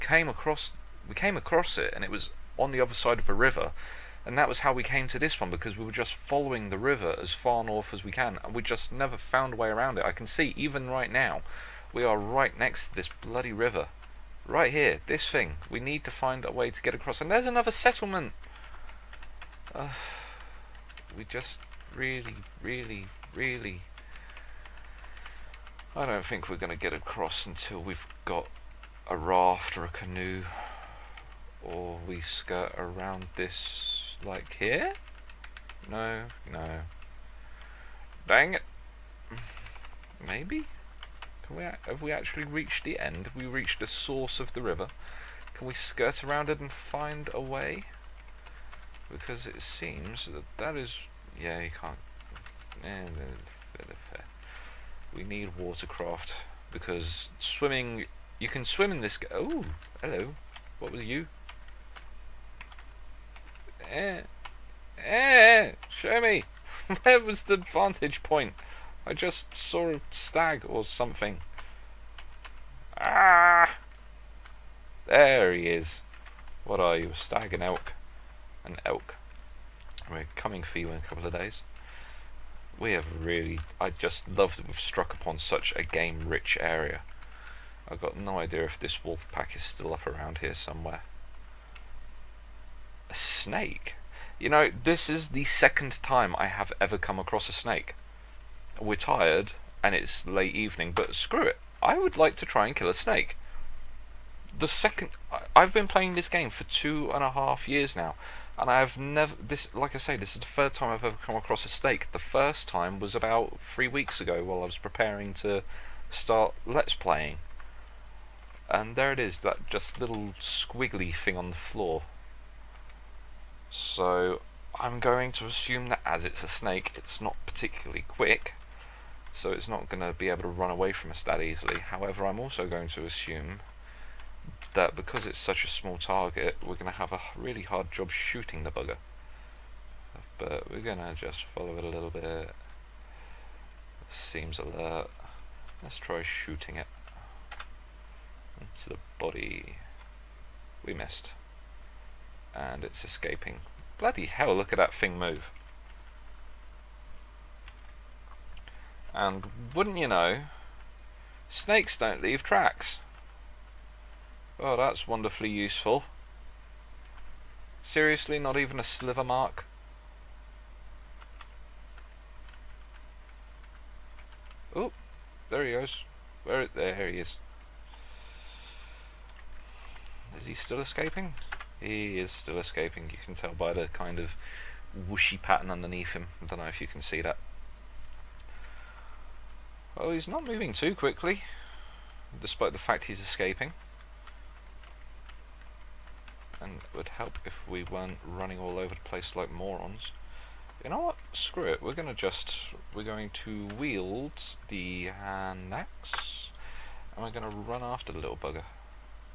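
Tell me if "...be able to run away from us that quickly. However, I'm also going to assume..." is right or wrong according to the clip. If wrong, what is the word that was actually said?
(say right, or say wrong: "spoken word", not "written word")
wrong: "easily", not "quickly".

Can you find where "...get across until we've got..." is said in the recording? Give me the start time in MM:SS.
00:26.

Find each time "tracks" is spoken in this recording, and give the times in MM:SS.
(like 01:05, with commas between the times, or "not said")
02:42.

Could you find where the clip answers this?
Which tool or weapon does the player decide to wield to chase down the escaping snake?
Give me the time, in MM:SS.
03:25.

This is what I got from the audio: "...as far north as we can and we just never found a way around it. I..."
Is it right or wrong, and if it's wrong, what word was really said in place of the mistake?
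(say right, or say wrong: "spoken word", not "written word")
right.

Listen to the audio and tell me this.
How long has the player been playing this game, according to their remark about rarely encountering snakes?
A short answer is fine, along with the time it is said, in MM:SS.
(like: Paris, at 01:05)
2 and a half years, at 01:46.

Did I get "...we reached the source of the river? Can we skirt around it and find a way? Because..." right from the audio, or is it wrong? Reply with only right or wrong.
right.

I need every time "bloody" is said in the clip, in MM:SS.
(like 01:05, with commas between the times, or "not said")
00:13, 02:33.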